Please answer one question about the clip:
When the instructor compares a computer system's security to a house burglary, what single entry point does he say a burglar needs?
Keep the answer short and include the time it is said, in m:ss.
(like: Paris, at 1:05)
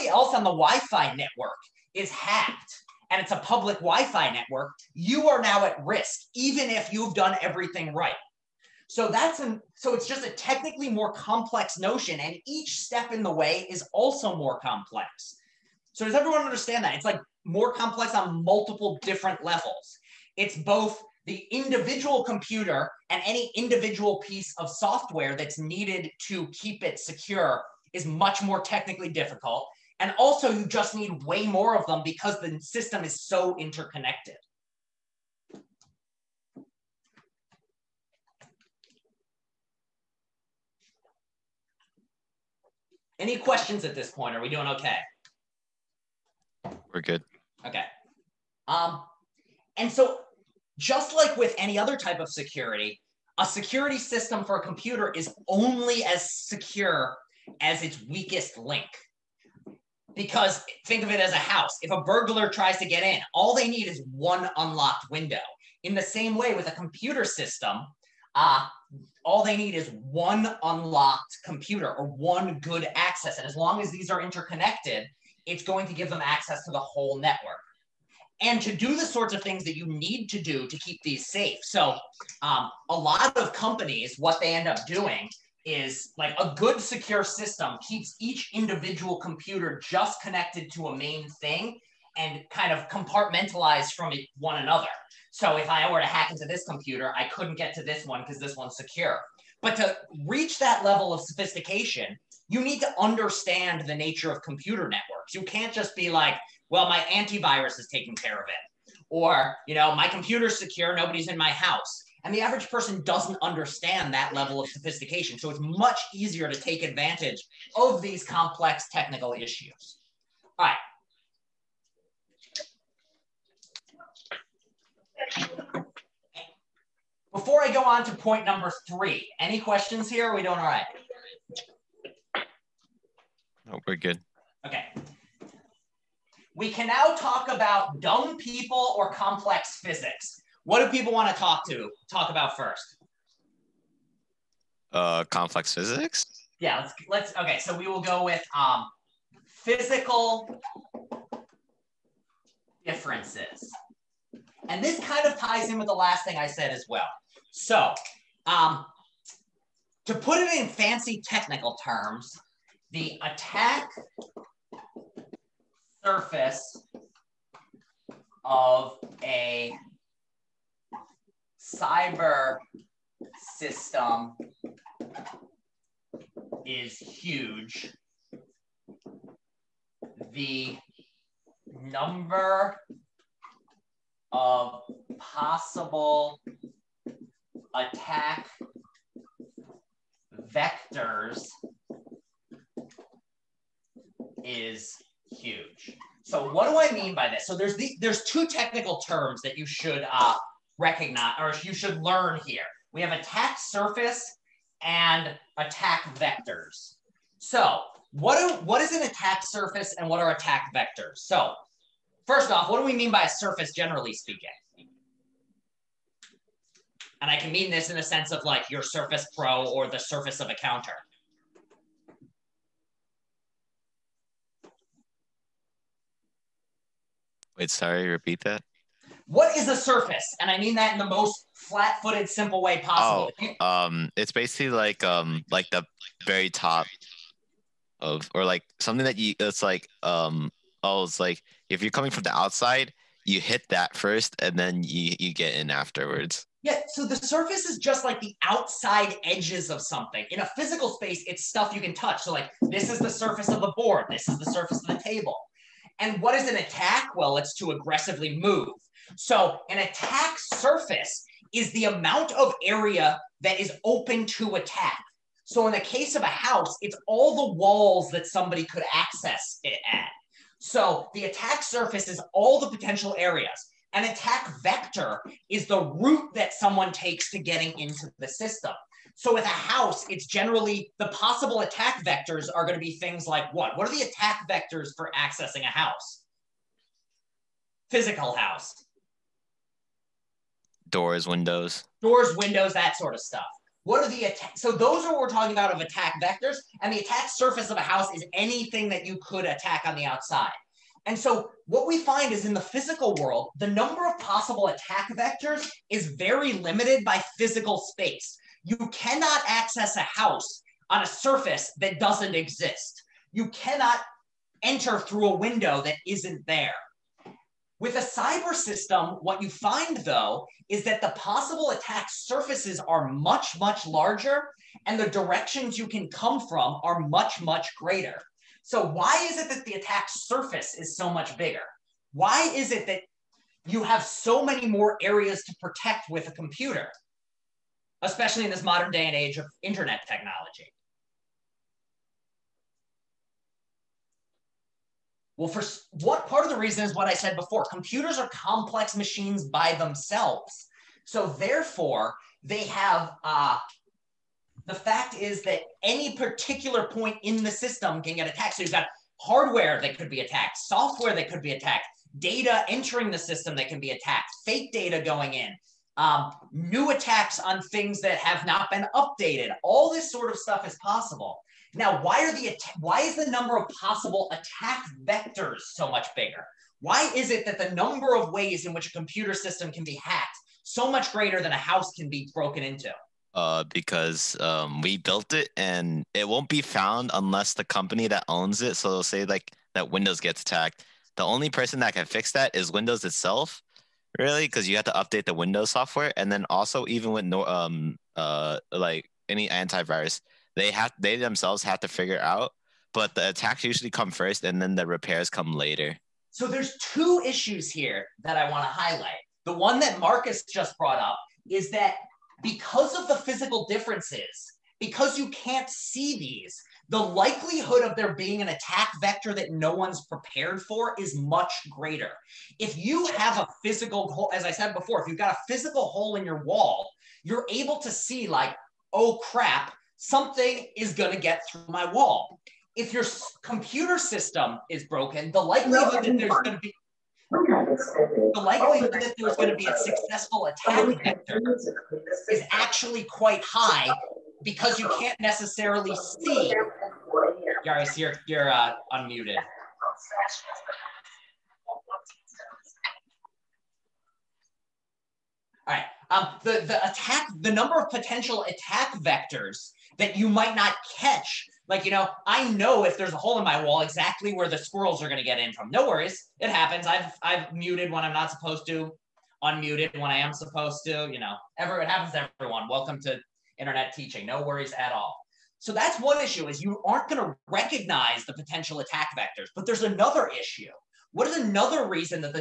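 One unlocked window, at 1:04.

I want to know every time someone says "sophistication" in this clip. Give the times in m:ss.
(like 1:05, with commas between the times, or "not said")
1:41, 1:54.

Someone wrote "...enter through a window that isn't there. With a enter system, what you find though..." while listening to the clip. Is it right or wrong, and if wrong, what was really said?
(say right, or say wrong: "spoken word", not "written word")
wrong: "cyber", not "enter".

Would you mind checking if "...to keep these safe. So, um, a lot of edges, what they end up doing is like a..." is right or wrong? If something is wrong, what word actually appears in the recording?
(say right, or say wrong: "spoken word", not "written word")
wrong: "companies", not "edges".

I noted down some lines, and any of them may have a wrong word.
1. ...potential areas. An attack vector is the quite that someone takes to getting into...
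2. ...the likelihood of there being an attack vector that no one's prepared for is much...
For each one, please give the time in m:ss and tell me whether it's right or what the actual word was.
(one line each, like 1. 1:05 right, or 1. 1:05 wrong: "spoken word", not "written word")
1. 4:32 wrong: "route", not "quite"
2. 6:56 right.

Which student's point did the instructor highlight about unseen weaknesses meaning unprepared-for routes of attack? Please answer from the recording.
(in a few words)
Marcus.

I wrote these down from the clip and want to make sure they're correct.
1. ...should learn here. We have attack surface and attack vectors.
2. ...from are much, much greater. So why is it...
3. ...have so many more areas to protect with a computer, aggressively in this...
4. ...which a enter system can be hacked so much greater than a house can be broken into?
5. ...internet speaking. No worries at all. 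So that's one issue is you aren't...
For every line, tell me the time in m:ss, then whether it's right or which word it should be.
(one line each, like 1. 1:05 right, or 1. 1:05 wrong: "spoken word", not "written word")
1. 3:21 right
2. 5:26 right
3. 5:33 wrong: "especially", not "aggressively"
4. 6:18 wrong: "computer", not "enter"
5. 7:53 wrong: "teaching", not "speaking".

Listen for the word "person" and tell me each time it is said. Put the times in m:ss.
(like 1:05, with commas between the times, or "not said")
1:52, 6:31.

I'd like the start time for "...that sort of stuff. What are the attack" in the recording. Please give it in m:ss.
4:52.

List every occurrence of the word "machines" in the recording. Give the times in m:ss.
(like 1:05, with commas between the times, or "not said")
5:48.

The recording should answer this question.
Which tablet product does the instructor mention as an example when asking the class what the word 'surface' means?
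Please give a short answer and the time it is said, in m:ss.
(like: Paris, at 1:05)
Surface Pro, at 3:38.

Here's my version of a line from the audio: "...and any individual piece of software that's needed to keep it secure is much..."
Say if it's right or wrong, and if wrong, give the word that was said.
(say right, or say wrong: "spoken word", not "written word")
right.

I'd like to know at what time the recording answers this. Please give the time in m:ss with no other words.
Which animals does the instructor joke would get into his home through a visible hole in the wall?
7:44.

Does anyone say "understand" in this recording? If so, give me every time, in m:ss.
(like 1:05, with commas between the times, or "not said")
0:16, 1:42, 1:53.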